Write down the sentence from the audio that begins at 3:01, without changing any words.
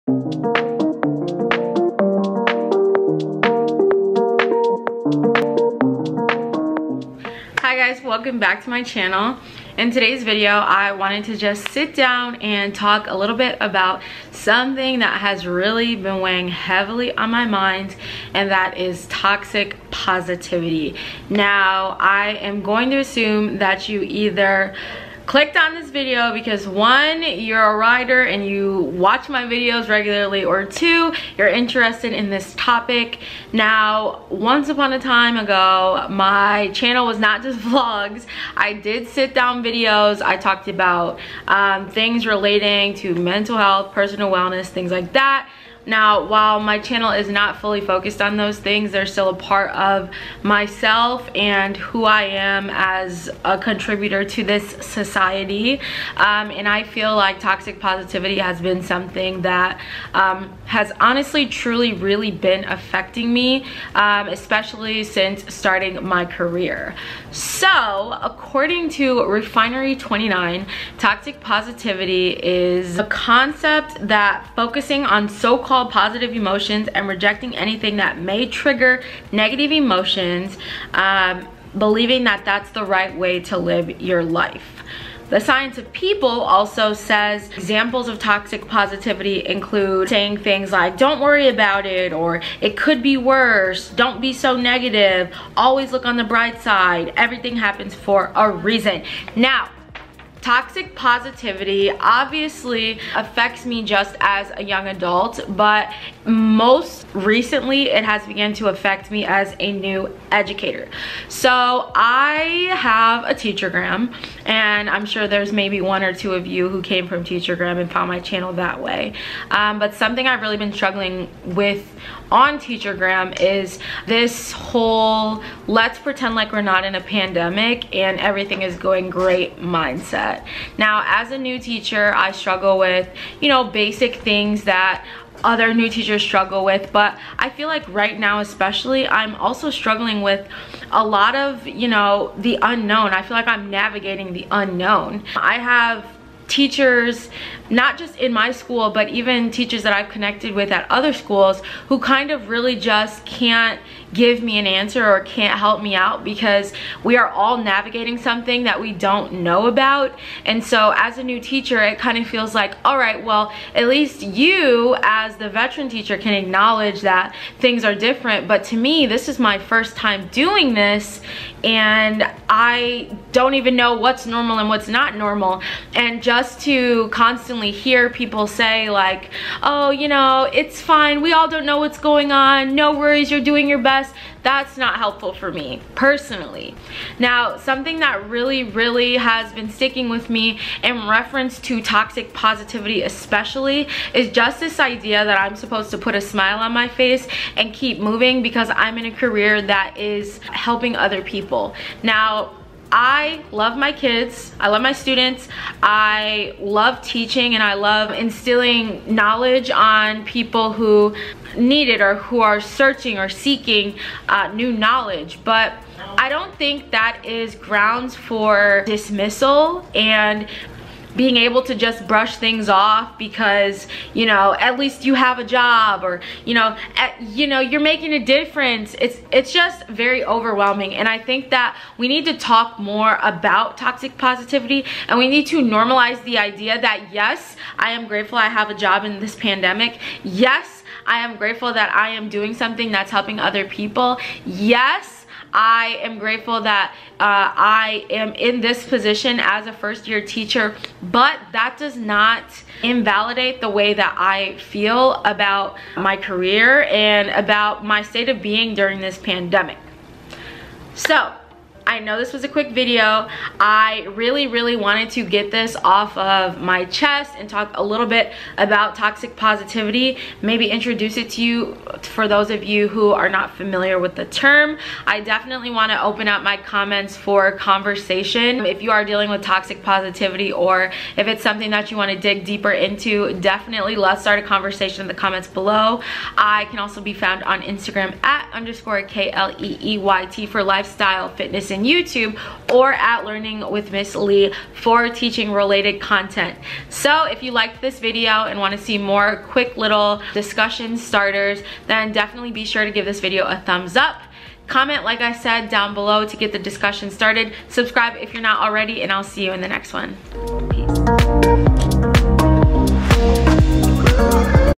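We all don't know what's going on.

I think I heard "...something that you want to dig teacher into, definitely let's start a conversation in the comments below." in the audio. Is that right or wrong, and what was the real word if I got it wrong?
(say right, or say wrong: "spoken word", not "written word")
wrong: "deeper", not "teacher".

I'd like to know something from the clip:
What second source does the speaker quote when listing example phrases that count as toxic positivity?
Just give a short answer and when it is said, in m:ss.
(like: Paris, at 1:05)
The Science of People, at 1:25.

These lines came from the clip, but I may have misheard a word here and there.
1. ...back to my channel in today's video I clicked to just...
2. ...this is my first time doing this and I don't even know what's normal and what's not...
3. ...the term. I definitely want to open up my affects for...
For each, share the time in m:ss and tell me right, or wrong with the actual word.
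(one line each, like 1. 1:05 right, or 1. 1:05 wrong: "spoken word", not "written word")
1. 0:08 wrong: "wanted", not "clicked"
2. 2:49 right
3. 4:34 wrong: "comments", not "affects".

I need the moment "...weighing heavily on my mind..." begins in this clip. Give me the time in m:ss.
0:16.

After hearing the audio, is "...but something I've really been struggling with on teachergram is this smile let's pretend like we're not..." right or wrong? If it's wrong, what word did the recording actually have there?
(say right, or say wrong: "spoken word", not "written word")
wrong: "whole", not "smile".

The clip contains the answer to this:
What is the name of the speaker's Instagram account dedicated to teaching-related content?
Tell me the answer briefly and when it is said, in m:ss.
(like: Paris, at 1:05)
Learning with Miss Lee, at 4:53.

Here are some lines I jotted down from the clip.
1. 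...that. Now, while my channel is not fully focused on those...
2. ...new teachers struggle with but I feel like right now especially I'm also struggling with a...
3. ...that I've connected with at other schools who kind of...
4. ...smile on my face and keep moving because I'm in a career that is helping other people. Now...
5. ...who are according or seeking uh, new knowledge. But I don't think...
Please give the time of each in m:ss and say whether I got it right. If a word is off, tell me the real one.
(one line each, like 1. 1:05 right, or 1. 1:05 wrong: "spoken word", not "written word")
1. 0:45 right
2. 2:15 right
3. 2:29 right
4. 3:16 right
5. 3:32 wrong: "searching", not "according".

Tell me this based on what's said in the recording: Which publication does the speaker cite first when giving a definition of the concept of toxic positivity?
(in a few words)
Refinery29.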